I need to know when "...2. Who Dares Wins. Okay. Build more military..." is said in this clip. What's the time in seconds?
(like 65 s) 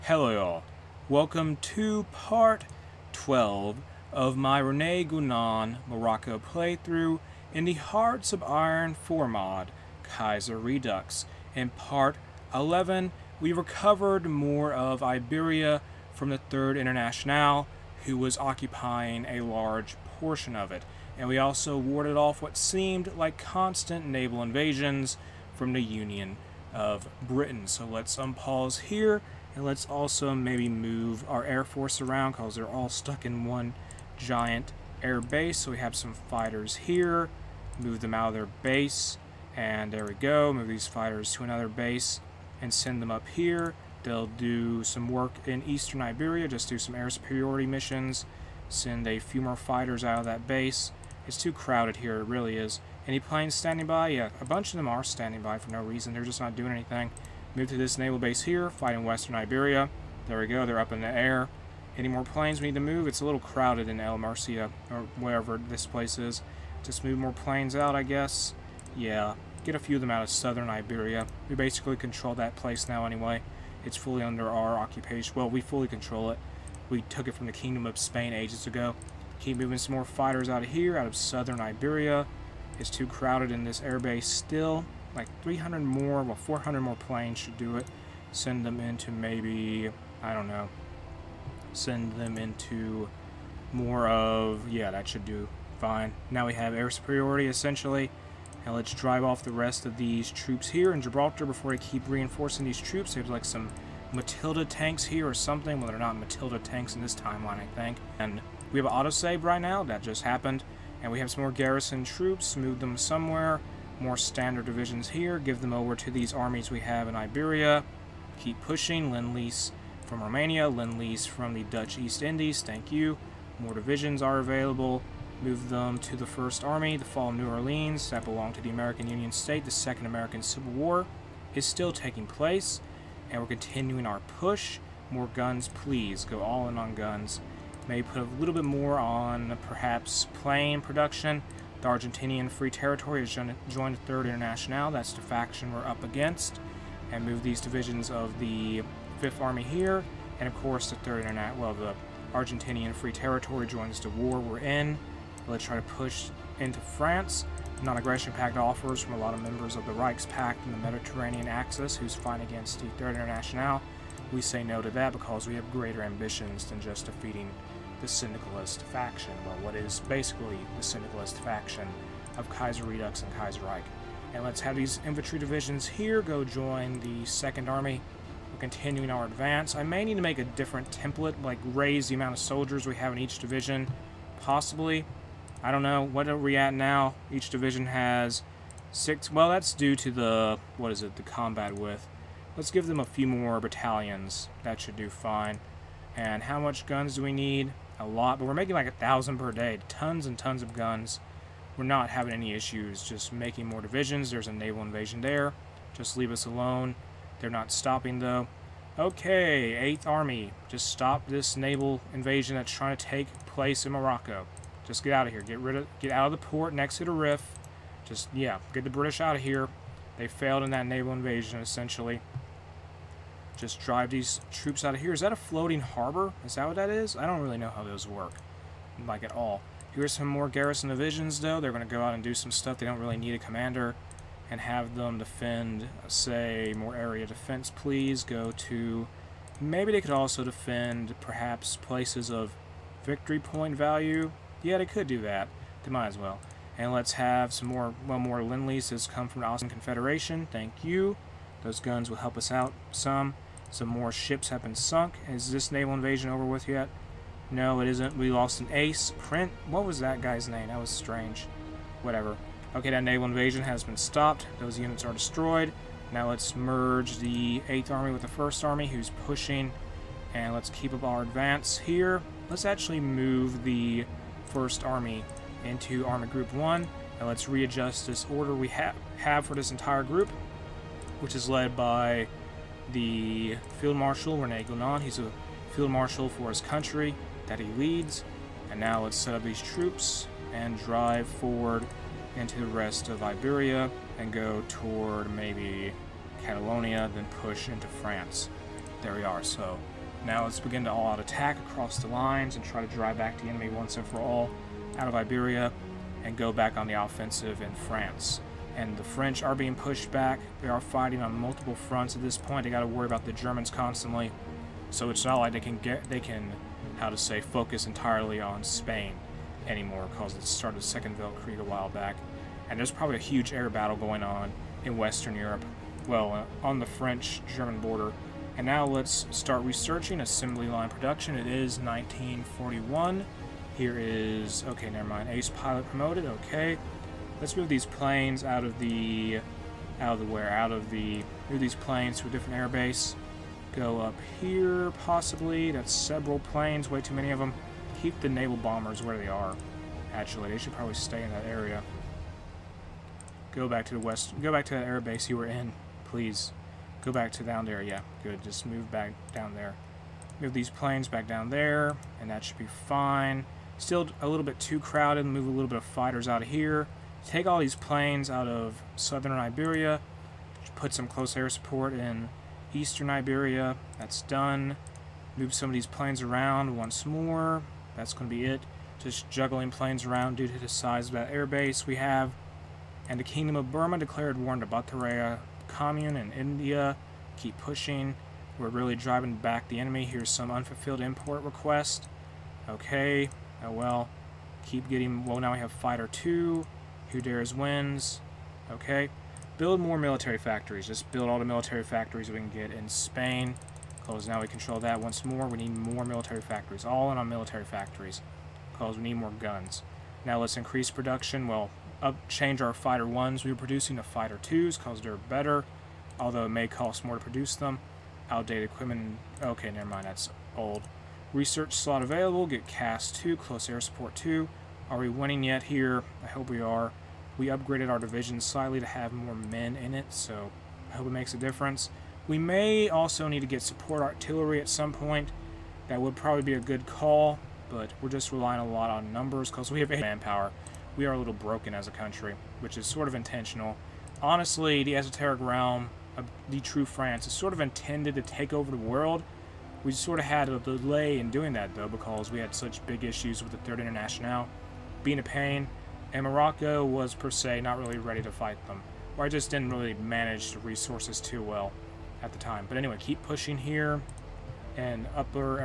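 396 s.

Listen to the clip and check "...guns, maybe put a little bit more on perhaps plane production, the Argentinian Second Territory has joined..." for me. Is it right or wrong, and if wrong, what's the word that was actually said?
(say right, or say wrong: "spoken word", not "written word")
wrong: "Free", not "Second".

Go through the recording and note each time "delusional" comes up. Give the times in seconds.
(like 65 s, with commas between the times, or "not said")
not said.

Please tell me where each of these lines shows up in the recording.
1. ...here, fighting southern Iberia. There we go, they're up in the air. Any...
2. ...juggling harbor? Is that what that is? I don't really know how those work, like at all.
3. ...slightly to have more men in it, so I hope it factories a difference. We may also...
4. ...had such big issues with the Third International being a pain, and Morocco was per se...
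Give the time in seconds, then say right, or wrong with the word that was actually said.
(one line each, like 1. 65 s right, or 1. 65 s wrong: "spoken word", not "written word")
1. 58 s wrong: "western", not "southern"
2. 225 s wrong: "floating", not "juggling"
3. 428 s wrong: "makes", not "factories"
4. 452 s right.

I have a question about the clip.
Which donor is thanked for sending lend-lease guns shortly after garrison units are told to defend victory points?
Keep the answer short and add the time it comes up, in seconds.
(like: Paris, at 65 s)
Austin Confederation, at 249 s.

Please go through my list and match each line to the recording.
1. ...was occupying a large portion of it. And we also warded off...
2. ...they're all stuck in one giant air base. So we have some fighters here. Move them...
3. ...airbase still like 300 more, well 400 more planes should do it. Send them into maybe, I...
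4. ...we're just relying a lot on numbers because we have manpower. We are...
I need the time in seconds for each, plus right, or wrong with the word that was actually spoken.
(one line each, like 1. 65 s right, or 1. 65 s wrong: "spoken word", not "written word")
1. 18 s right
2. 32 s right
3. 83 s right
4. 438 s right.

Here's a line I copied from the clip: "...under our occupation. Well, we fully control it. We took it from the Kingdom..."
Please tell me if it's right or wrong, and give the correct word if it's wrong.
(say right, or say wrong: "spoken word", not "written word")
right.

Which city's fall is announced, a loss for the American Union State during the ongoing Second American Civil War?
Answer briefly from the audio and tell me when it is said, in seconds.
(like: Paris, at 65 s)
New Orleans, at 127 s.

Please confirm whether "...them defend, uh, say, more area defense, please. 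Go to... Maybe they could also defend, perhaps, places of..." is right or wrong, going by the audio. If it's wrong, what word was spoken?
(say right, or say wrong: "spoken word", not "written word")
right.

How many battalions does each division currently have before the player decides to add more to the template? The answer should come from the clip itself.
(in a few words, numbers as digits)
6.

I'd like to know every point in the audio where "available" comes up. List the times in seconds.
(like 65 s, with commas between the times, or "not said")
124 s, 422 s.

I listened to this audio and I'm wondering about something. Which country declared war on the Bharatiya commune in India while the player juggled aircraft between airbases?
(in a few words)
Kingdom of Burma.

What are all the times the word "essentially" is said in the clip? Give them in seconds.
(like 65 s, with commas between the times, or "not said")
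97 s, 221 s.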